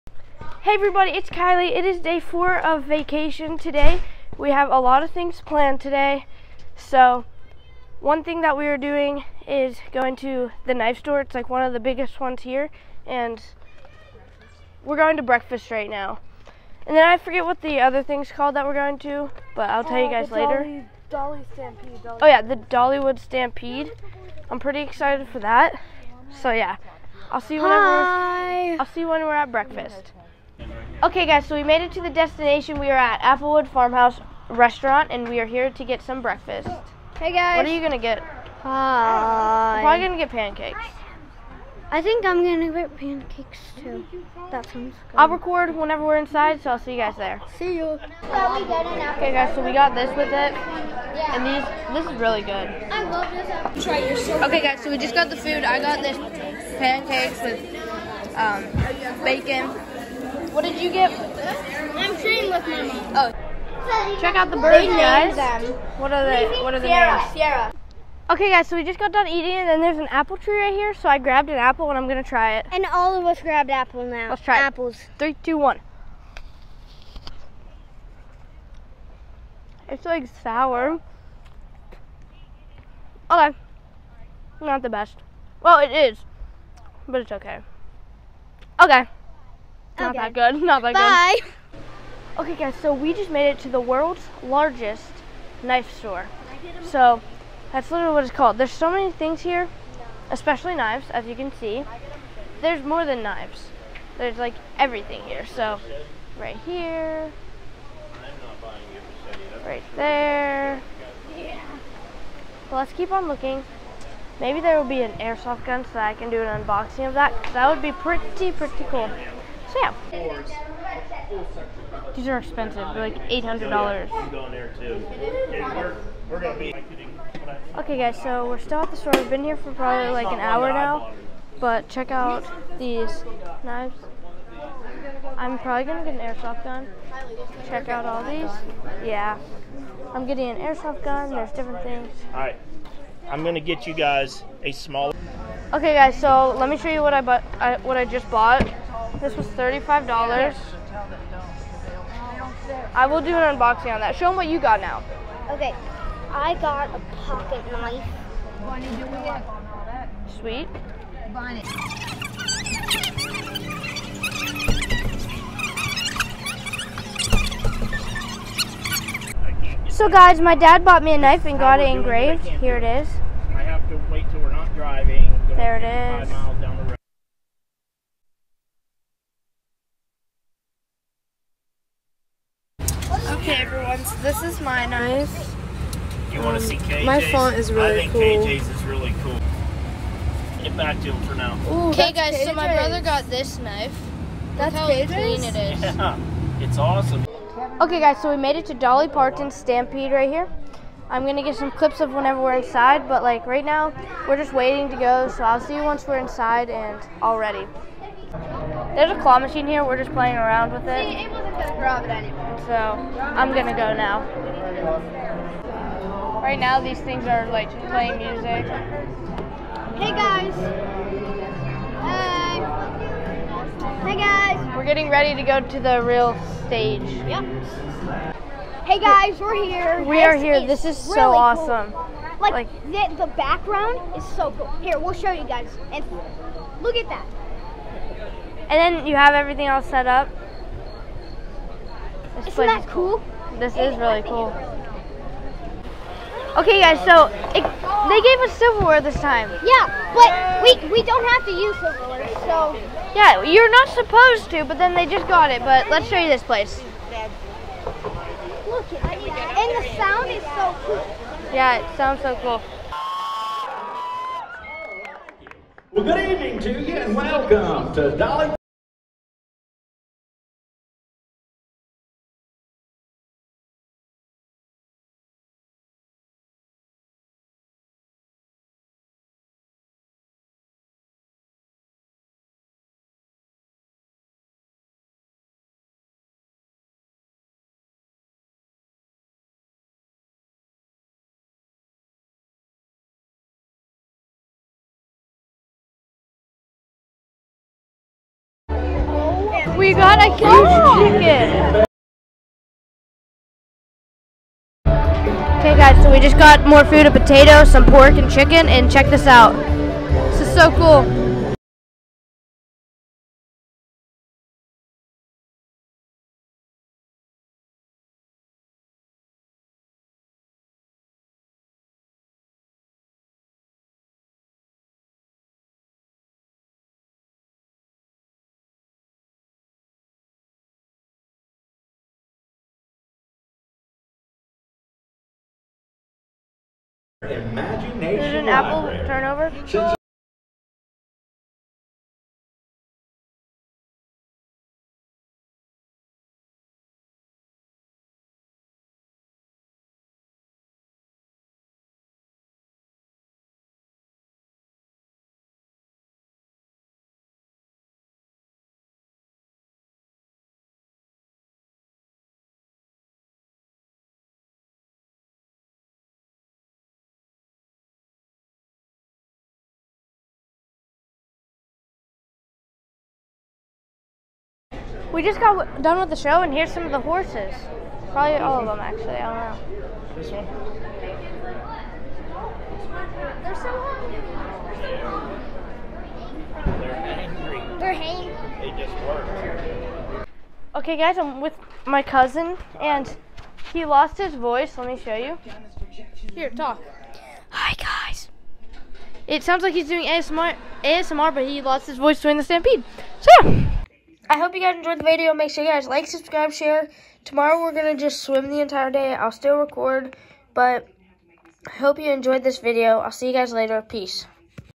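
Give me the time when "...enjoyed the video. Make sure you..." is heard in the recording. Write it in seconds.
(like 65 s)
404 s.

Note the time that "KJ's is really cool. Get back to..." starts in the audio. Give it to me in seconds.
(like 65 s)
188 s.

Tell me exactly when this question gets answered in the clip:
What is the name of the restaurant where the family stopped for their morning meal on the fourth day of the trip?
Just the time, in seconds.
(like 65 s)
33 s.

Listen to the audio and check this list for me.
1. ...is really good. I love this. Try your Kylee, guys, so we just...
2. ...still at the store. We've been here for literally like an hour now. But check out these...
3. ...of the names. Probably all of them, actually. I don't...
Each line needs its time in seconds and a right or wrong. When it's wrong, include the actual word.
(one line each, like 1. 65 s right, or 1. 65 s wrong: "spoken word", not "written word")
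1. 52 s wrong: "Okay", not "Kylee"
2. 128 s wrong: "probably", not "literally"
3. 376 s wrong: "horses", not "names".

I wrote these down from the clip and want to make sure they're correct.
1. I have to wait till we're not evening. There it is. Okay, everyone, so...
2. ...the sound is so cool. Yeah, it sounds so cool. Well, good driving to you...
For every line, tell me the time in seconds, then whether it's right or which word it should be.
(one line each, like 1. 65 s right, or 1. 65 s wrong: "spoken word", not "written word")
1. 173 s wrong: "driving", not "evening"
2. 259 s wrong: "evening", not "driving".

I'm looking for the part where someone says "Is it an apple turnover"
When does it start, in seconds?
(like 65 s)
338 s.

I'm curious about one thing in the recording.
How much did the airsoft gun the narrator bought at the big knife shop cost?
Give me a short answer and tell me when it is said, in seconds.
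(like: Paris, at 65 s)
$35, at 149 s.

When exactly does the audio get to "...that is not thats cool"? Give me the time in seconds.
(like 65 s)
242 s.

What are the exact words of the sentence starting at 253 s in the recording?
Yeah, you're not supposed to, but then they just got it.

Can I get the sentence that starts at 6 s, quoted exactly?
So, one thing that we are doing is going to the knife store.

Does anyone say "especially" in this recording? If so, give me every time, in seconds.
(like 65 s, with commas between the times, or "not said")
100 s.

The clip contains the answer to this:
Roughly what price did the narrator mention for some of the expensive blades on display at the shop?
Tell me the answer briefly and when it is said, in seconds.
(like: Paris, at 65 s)
$800, at 123 s.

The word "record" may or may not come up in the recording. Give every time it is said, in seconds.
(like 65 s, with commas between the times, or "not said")
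45 s, 409 s.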